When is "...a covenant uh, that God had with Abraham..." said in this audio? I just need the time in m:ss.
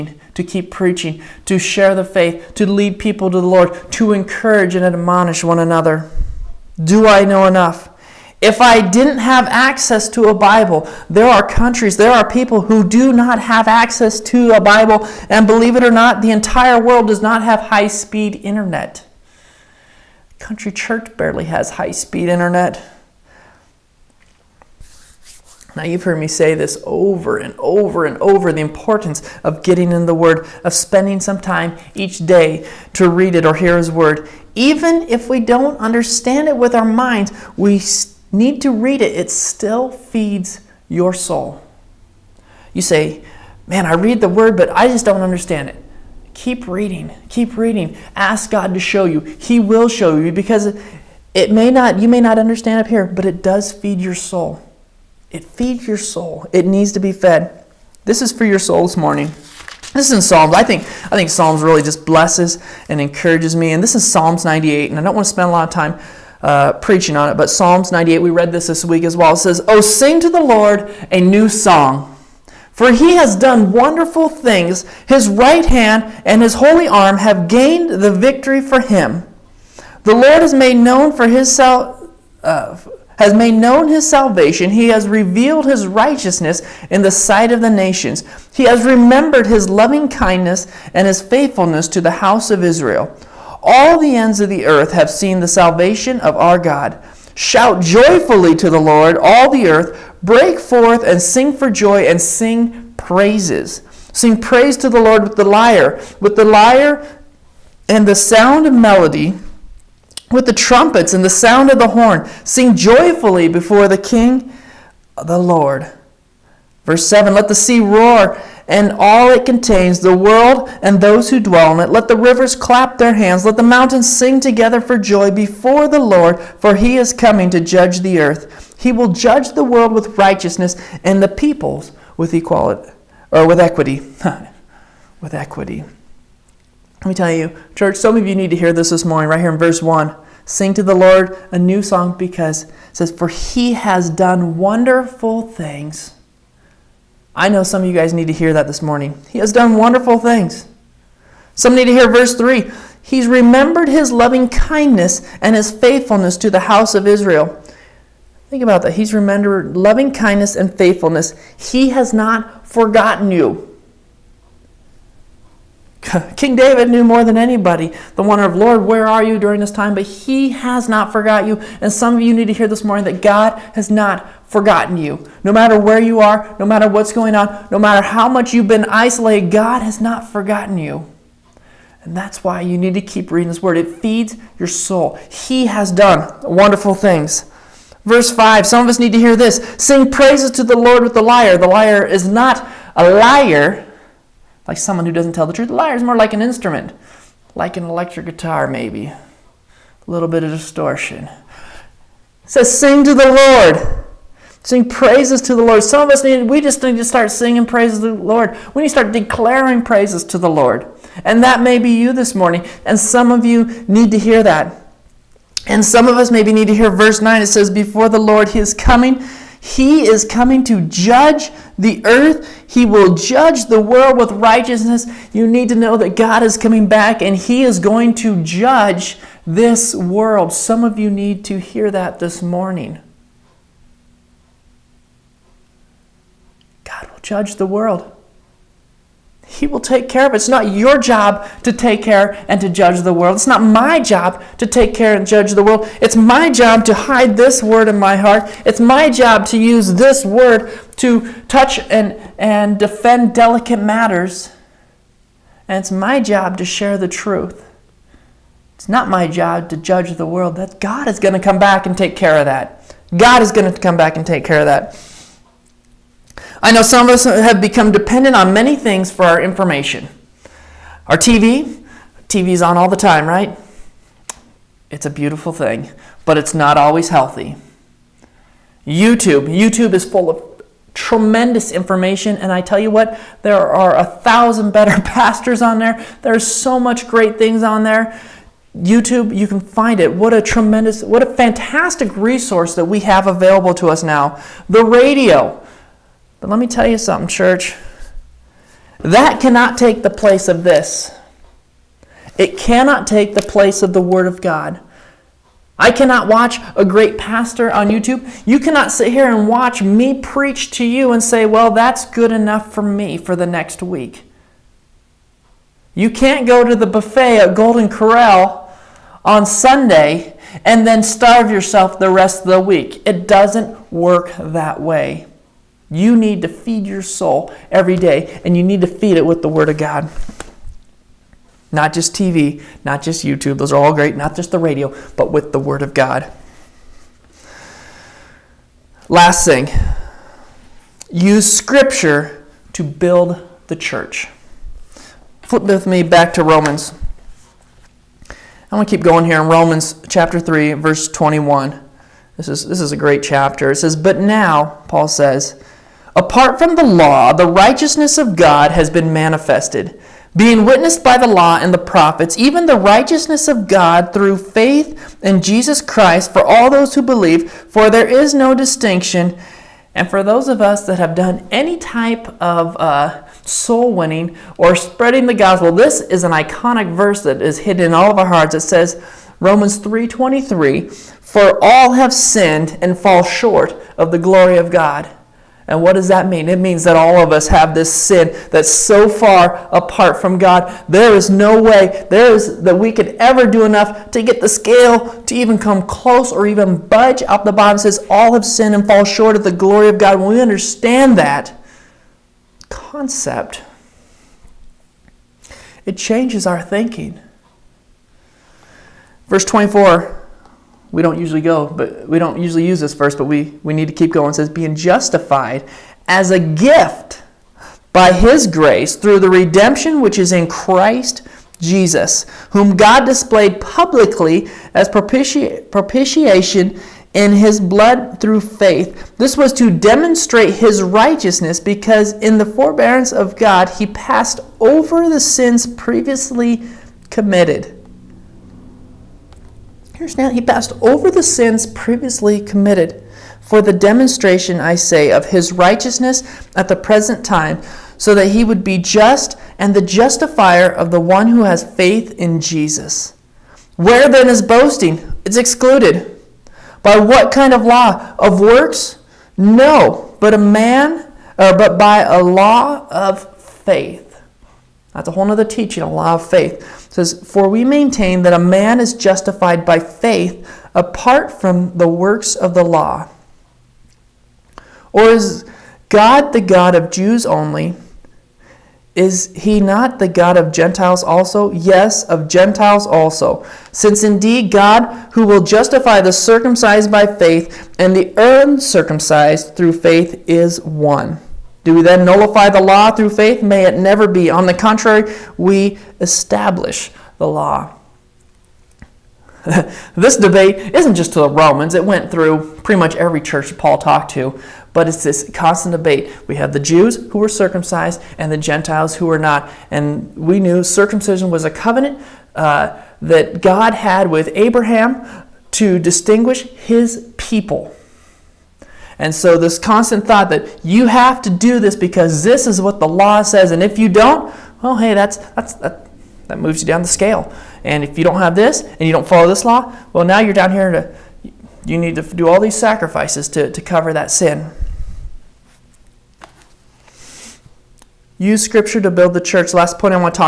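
8:31.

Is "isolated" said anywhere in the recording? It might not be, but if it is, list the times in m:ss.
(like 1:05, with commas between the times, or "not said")
2:58.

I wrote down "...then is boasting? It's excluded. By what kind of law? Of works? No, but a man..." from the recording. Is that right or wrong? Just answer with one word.
right.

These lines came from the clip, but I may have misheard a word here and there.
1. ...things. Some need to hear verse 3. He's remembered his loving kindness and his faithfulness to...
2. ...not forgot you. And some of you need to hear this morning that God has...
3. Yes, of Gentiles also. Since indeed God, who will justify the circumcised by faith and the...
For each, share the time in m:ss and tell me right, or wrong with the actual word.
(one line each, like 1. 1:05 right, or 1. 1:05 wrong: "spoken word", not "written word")
1. 2:30 right
2. 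2:50 right
3. 8:01 right.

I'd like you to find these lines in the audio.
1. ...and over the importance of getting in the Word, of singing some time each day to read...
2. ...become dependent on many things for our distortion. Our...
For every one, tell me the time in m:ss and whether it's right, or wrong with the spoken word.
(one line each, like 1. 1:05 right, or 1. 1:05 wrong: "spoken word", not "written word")
1. 0:28 wrong: "spending", not "singing"
2. 4:27 wrong: "information", not "distortion".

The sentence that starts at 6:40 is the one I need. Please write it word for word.
When we understand that concept, it changes our thinking.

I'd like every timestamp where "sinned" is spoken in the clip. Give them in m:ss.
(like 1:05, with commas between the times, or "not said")
6:22, 6:38.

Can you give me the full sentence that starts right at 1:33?
All the ends of the earth have seen the salvation of our God.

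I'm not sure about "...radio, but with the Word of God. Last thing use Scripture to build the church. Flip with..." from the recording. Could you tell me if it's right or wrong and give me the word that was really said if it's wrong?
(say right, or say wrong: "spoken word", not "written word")
right.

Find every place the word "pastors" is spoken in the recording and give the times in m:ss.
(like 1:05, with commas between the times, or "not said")
4:45, 5:07.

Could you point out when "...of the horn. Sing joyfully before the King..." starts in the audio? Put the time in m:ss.
1:51.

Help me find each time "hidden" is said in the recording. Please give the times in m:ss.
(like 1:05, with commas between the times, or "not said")
6:17.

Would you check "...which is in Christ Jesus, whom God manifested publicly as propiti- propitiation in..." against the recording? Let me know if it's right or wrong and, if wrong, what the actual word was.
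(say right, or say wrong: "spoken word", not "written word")
wrong: "displayed", not "manifested".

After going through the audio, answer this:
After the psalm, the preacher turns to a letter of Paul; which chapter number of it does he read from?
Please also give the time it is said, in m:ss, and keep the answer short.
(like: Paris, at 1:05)
3, at 5:49.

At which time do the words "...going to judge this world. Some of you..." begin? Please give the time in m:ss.
3:47.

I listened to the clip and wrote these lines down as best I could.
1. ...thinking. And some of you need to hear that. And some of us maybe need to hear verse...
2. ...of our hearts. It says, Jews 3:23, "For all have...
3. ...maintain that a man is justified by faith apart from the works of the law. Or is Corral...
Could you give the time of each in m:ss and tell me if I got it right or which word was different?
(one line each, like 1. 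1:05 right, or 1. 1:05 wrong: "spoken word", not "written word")
1. 3:32 wrong: "morning", not "thinking"
2. 6:18 wrong: "Romans", not "Jews"
3. 7:47 wrong: "God", not "Corral".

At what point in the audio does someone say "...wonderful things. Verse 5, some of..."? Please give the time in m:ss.
3:06.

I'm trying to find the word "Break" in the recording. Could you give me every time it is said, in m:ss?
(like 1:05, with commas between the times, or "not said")
1:40.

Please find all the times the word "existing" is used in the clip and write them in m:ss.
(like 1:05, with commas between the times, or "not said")
not said.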